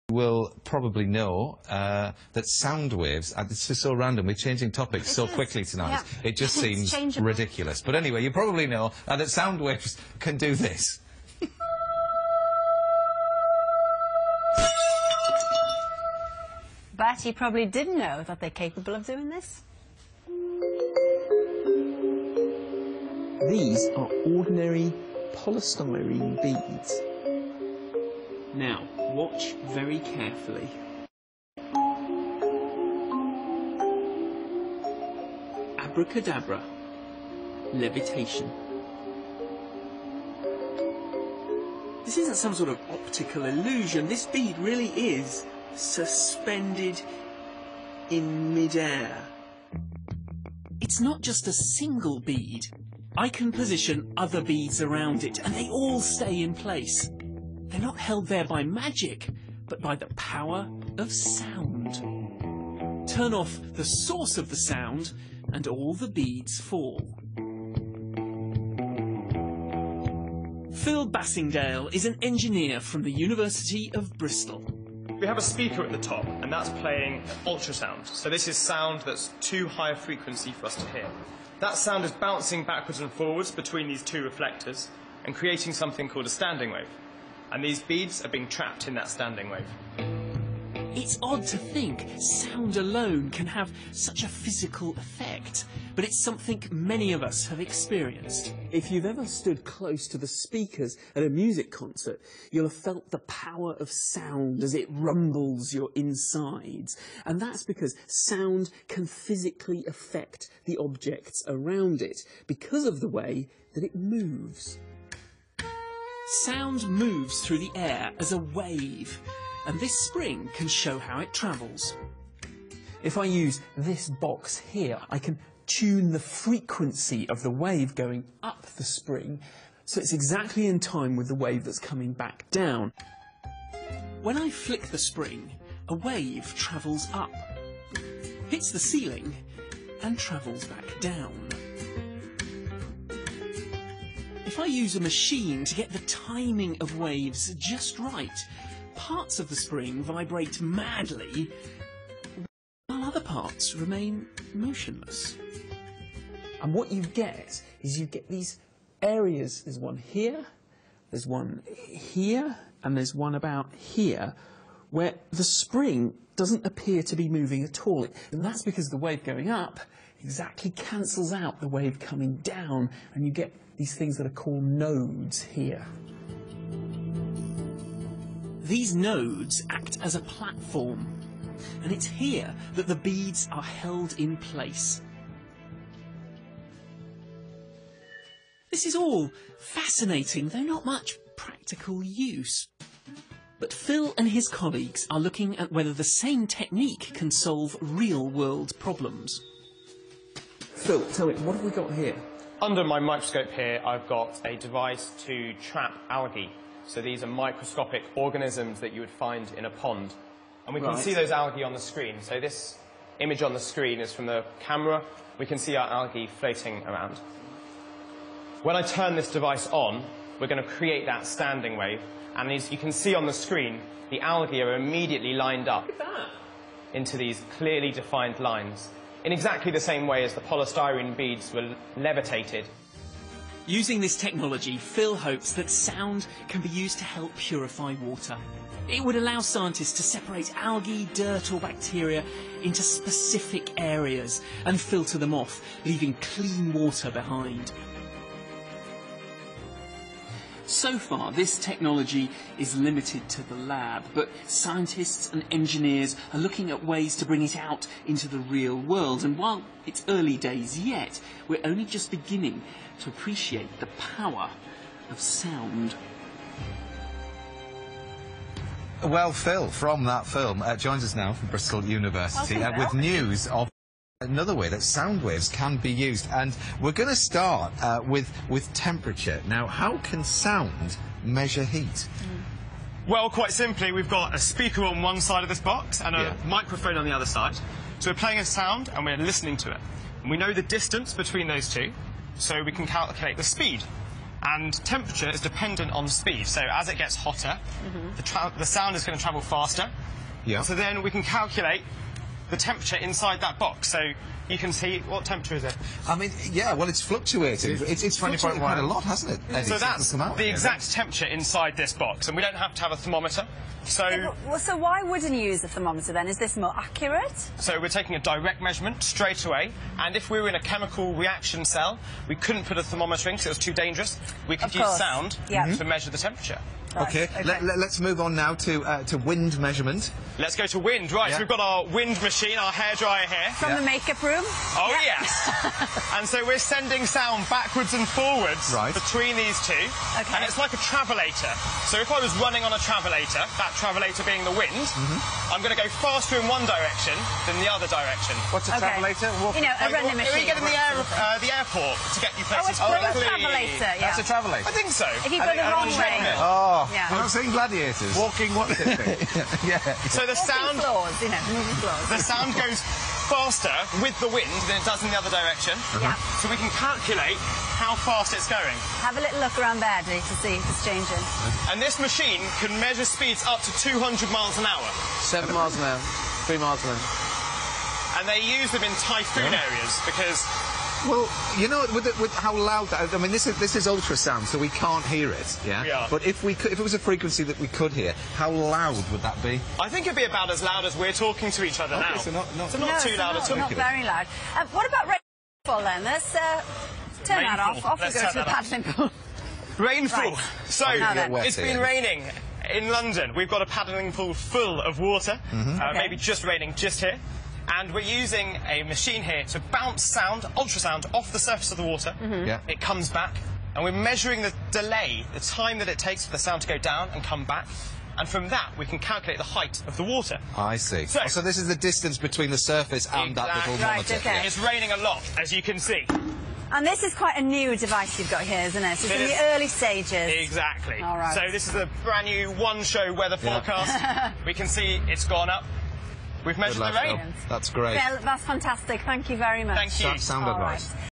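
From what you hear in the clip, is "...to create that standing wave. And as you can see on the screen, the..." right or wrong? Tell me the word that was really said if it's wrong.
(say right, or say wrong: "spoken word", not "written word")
right.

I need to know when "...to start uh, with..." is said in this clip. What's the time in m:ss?
4:37.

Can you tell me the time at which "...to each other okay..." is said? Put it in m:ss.
6:31.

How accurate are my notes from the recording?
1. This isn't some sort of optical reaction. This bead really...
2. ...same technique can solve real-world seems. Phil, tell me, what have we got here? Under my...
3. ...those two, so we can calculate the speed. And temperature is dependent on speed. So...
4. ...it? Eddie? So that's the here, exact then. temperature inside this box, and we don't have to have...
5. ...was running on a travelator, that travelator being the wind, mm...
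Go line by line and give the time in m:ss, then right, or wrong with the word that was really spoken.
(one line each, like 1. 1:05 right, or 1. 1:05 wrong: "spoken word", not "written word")
1. 0:42 wrong: "illusion", not "reaction"
2. 3:16 wrong: "problems", not "seems"
3. 4:51 right
4. 5:09 right
5. 5:42 right.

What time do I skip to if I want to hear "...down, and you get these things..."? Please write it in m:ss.
2:52.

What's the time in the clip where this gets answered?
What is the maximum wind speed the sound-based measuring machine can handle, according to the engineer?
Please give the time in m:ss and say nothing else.
6:13.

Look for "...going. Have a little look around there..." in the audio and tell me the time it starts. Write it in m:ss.
6:08.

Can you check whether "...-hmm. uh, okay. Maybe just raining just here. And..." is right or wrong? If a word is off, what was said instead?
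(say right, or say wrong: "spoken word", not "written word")
right.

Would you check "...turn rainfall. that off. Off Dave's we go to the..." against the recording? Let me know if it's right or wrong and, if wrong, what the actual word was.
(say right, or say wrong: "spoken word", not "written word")
wrong: "Let", not "Dave".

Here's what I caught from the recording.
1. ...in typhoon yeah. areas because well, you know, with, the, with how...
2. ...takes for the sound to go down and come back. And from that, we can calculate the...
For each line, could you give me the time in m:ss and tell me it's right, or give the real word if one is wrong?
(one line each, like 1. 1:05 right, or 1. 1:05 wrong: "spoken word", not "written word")
1. 6:18 right
2. 6:55 right.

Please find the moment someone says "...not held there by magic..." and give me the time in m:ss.
0:57.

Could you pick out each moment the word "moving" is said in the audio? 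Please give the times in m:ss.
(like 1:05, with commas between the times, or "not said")
2:47, 6:01.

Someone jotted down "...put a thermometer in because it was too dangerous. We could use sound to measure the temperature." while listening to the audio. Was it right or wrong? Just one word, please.
right.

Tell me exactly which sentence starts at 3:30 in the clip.
can see those algae on the screen.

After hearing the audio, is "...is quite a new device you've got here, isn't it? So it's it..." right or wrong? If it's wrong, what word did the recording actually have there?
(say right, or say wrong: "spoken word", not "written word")
right.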